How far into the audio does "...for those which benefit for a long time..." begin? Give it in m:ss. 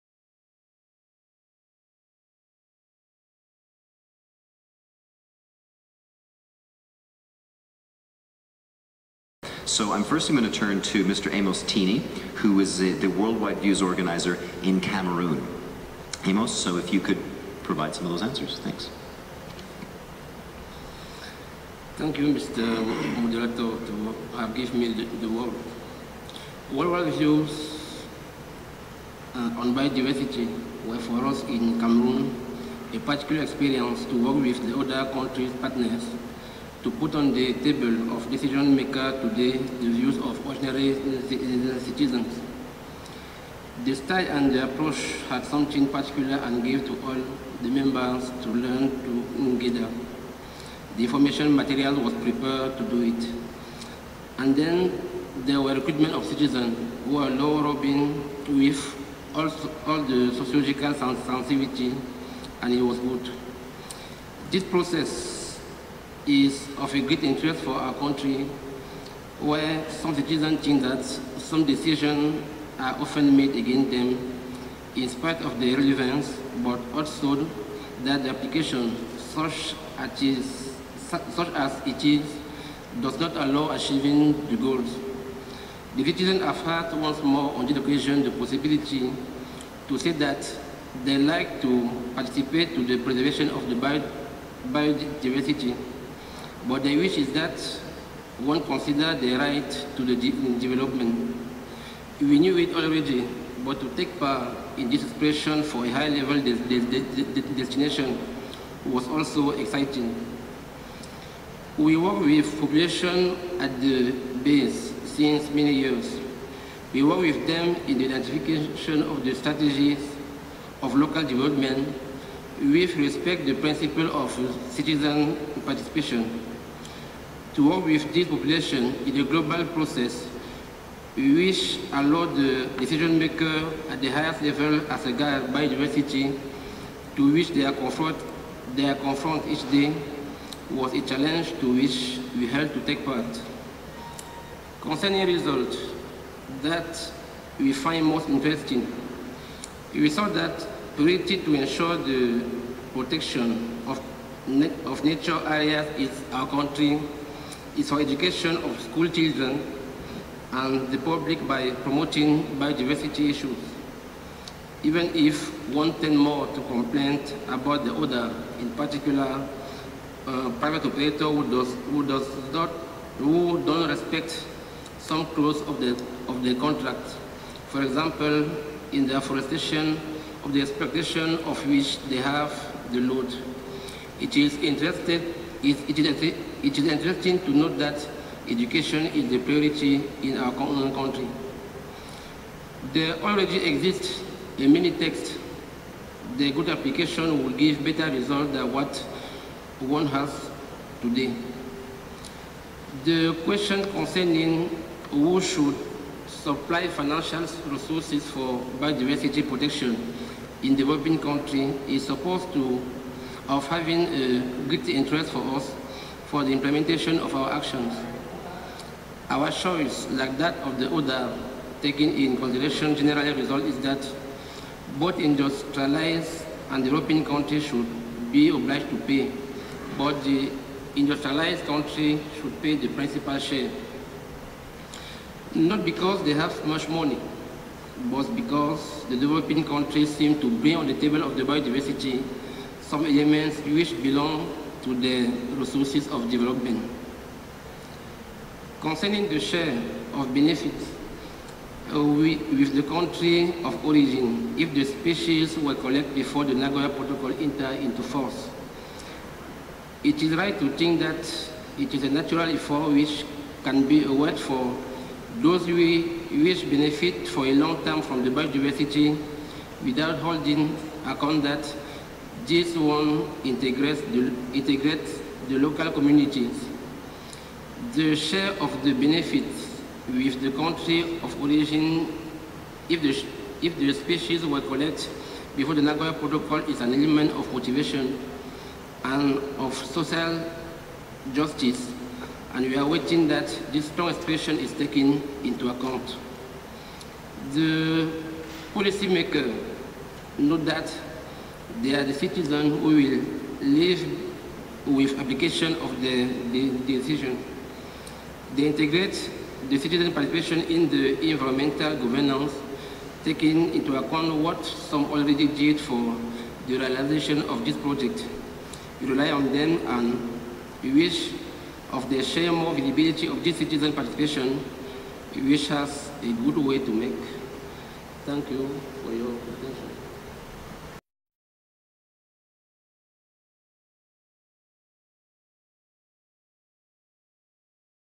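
4:24.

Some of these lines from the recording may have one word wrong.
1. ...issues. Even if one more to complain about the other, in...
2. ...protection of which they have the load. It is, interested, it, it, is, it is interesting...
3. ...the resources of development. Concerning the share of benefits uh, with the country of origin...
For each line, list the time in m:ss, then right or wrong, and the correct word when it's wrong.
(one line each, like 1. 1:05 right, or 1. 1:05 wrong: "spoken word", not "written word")
1. 2:43 right
2. 3:00 wrong: "expectation", not "protection"
3. 4:04 right.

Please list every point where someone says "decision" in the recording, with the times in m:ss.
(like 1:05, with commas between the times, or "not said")
0:38, 1:11, 2:12, 5:06.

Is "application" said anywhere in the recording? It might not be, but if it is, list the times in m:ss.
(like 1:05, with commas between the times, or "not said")
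1:18, 3:16, 5:05.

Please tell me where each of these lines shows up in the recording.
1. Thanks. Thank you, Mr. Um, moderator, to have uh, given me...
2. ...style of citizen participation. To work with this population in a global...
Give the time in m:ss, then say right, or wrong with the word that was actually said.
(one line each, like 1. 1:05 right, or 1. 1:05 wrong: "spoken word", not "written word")
1. 0:18 right
2. 2:03 wrong: "principle", not "style".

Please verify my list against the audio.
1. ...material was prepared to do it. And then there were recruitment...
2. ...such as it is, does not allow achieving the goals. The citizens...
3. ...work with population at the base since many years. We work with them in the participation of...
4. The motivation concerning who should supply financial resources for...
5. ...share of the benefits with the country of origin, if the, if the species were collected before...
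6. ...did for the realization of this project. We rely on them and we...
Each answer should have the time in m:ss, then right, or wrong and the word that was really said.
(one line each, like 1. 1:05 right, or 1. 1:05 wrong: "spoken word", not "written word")
1. 0:51 right
2. 1:21 right
3. 1:51 wrong: "identification", not "participation"
4. 3:23 wrong: "question", not "motivation"
5. 4:38 right
6. 5:15 right.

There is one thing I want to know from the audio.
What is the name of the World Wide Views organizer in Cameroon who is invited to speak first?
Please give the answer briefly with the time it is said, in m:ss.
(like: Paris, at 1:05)
Amos Tene, at 0:11.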